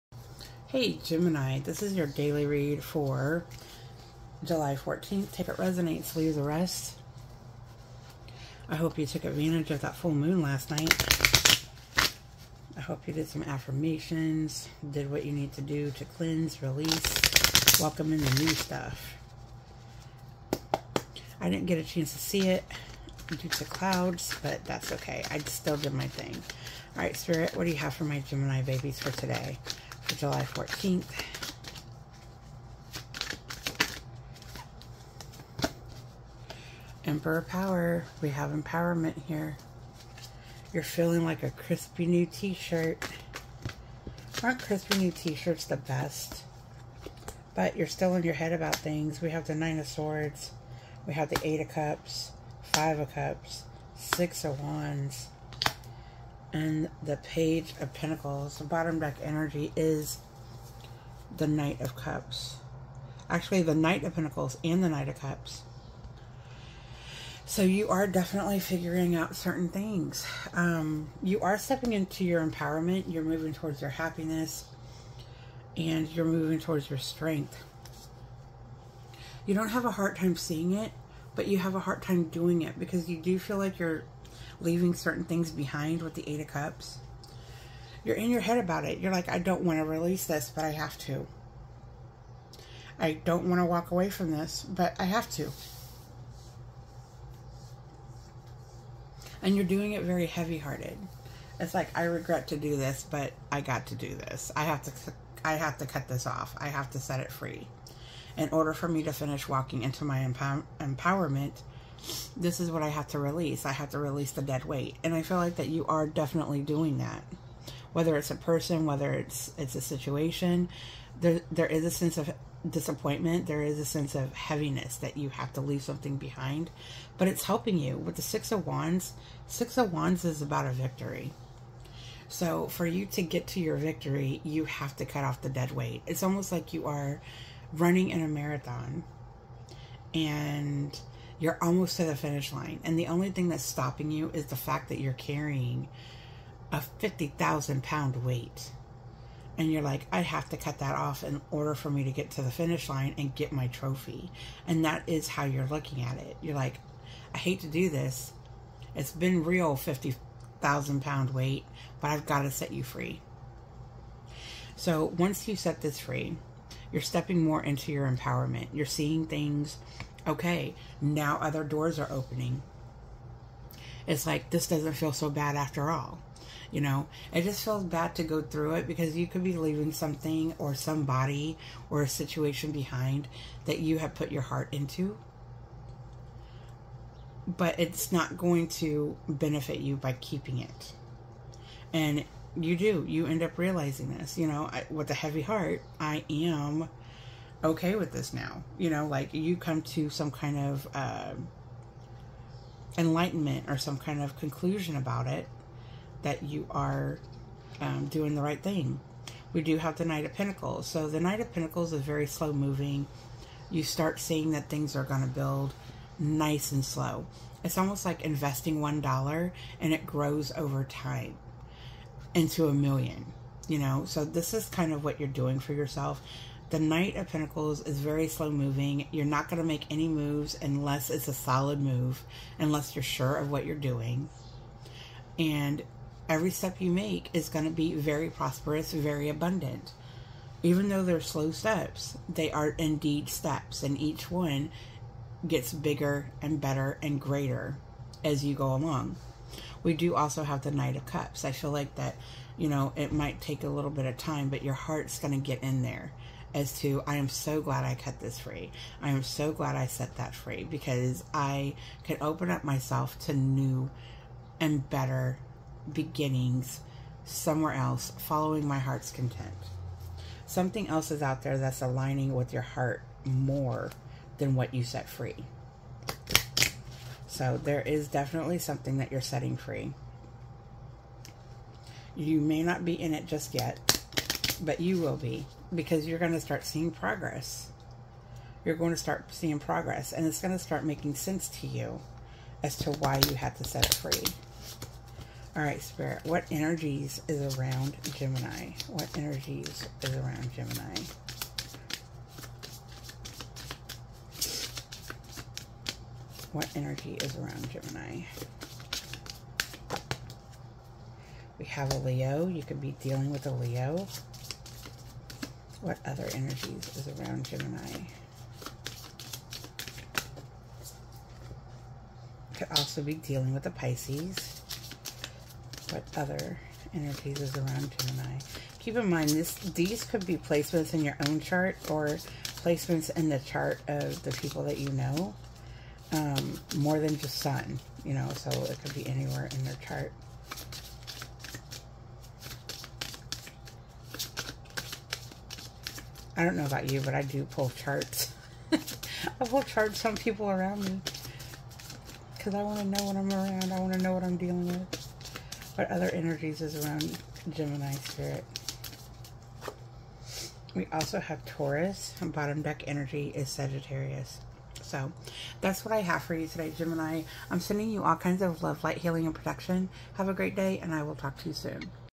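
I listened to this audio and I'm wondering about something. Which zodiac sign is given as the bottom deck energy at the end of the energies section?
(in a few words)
Sagittarius.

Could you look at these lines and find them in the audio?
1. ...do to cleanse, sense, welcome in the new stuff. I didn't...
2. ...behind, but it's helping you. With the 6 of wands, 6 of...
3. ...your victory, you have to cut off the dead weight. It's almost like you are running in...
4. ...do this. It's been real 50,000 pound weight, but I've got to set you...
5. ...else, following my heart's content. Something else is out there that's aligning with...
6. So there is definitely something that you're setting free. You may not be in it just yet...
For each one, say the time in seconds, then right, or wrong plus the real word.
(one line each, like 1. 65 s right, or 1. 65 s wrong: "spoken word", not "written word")
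1. 15 s wrong: "release", not "sense"
2. 126 s right
3. 133 s right
4. 157 s right
5. 267 s right
6. 277 s right.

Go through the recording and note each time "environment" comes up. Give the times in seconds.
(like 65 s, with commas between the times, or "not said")
not said.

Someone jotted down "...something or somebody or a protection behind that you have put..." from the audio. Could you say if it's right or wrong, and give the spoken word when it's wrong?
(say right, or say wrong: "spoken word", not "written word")
wrong: "situation", not "protection".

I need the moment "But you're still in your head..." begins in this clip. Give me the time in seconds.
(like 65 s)
47 s.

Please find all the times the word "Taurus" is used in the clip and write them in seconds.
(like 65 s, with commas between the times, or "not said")
361 s.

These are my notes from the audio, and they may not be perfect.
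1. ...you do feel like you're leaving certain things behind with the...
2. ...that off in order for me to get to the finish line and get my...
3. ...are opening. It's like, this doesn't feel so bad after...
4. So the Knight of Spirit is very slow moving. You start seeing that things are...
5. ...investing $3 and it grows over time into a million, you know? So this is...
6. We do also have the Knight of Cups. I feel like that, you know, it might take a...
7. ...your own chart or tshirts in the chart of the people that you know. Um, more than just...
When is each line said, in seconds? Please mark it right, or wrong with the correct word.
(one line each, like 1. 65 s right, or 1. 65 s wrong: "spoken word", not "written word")
1. 83 s right
2. 150 s right
3. 171 s right
4. 210 s wrong: "Pentacles", not "Spirit"
5. 218 s wrong: "1", not "3"
6. 249 s right
7. 331 s wrong: "placements", not "tshirts".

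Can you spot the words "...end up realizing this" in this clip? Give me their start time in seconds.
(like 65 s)
193 s.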